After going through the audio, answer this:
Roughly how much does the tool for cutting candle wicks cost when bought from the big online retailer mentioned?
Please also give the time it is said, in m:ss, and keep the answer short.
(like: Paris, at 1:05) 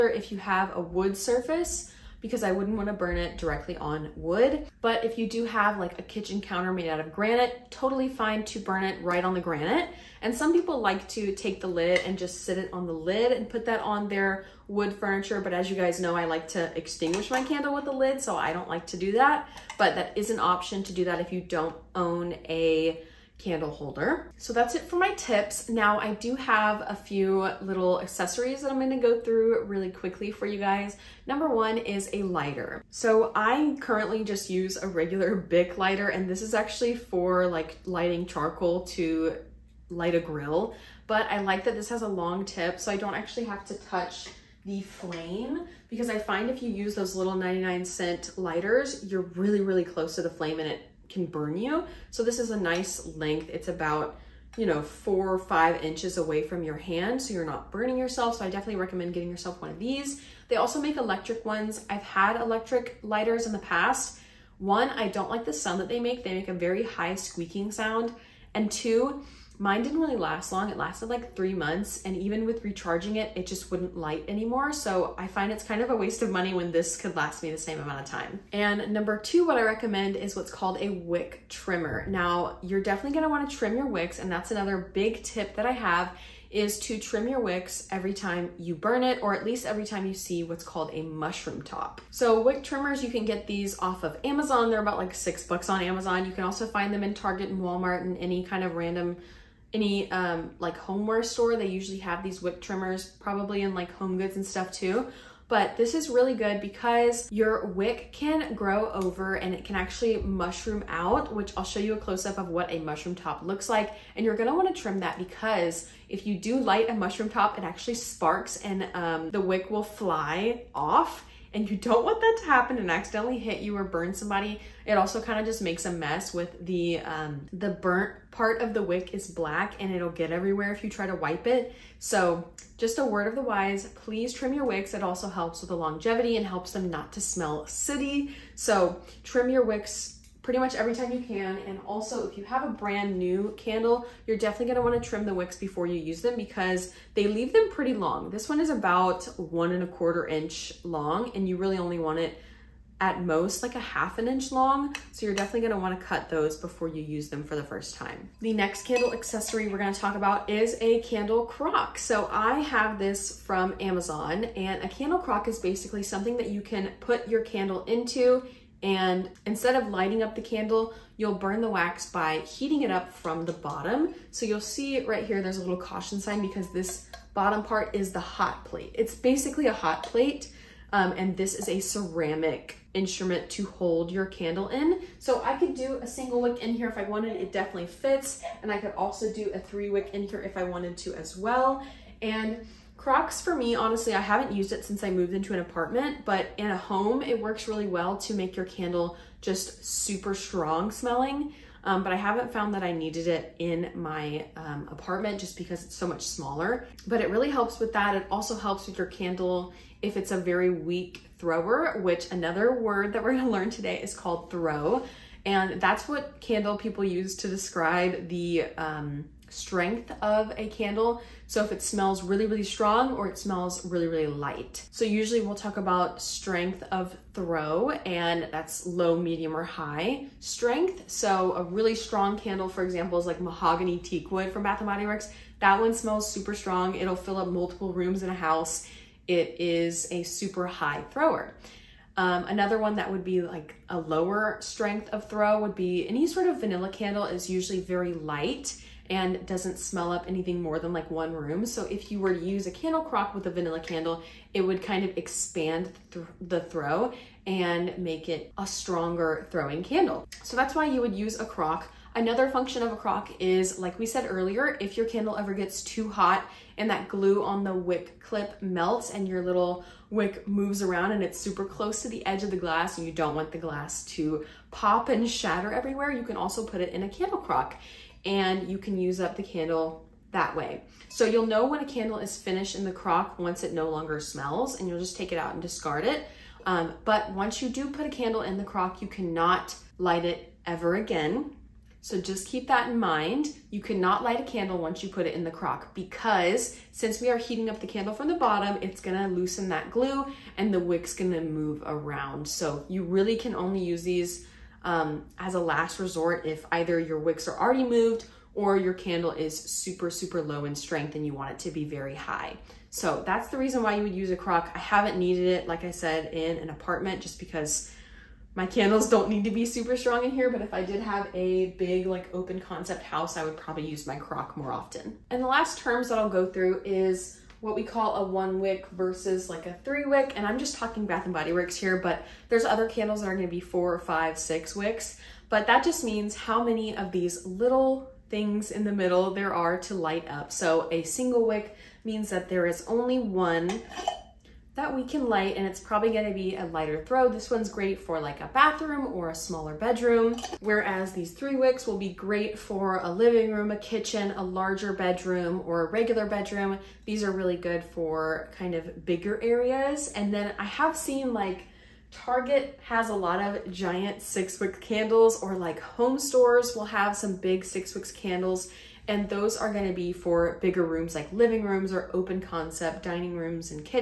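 $6, at 1:35.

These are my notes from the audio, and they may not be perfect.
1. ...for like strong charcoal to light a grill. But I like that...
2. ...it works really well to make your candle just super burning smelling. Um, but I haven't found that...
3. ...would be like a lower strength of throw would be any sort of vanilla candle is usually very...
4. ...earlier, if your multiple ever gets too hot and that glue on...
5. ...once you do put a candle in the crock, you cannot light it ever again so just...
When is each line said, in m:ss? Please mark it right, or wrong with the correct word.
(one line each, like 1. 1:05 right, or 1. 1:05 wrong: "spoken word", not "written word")
1. 0:36 wrong: "lighting", not "strong"
2. 3:17 wrong: "strong", not "burning"
3. 4:03 right
4. 4:24 wrong: "candle", not "multiple"
5. 4:47 right.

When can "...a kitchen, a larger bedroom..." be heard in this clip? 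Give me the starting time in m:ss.
5:53.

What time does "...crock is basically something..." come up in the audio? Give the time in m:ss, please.
2:45.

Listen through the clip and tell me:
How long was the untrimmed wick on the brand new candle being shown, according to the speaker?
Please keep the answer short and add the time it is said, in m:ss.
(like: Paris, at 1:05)
1 and a quarter inch, at 2:29.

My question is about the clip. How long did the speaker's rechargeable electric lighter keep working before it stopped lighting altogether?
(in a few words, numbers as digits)
3 months.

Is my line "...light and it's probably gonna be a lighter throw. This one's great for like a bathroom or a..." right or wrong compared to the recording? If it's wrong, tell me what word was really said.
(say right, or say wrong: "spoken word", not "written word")
right.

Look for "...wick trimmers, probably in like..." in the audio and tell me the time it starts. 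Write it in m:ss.
1:42.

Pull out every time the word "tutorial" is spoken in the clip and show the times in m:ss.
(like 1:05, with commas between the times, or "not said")
not said.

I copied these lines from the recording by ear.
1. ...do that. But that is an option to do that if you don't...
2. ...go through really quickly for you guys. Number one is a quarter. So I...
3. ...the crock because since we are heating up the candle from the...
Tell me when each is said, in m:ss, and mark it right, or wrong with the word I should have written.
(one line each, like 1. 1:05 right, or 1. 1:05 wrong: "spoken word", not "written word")
1. 0:18 right
2. 0:28 wrong: "lighter", not "quarter"
3. 4:55 right.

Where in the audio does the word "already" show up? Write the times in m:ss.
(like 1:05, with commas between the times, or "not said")
5:07.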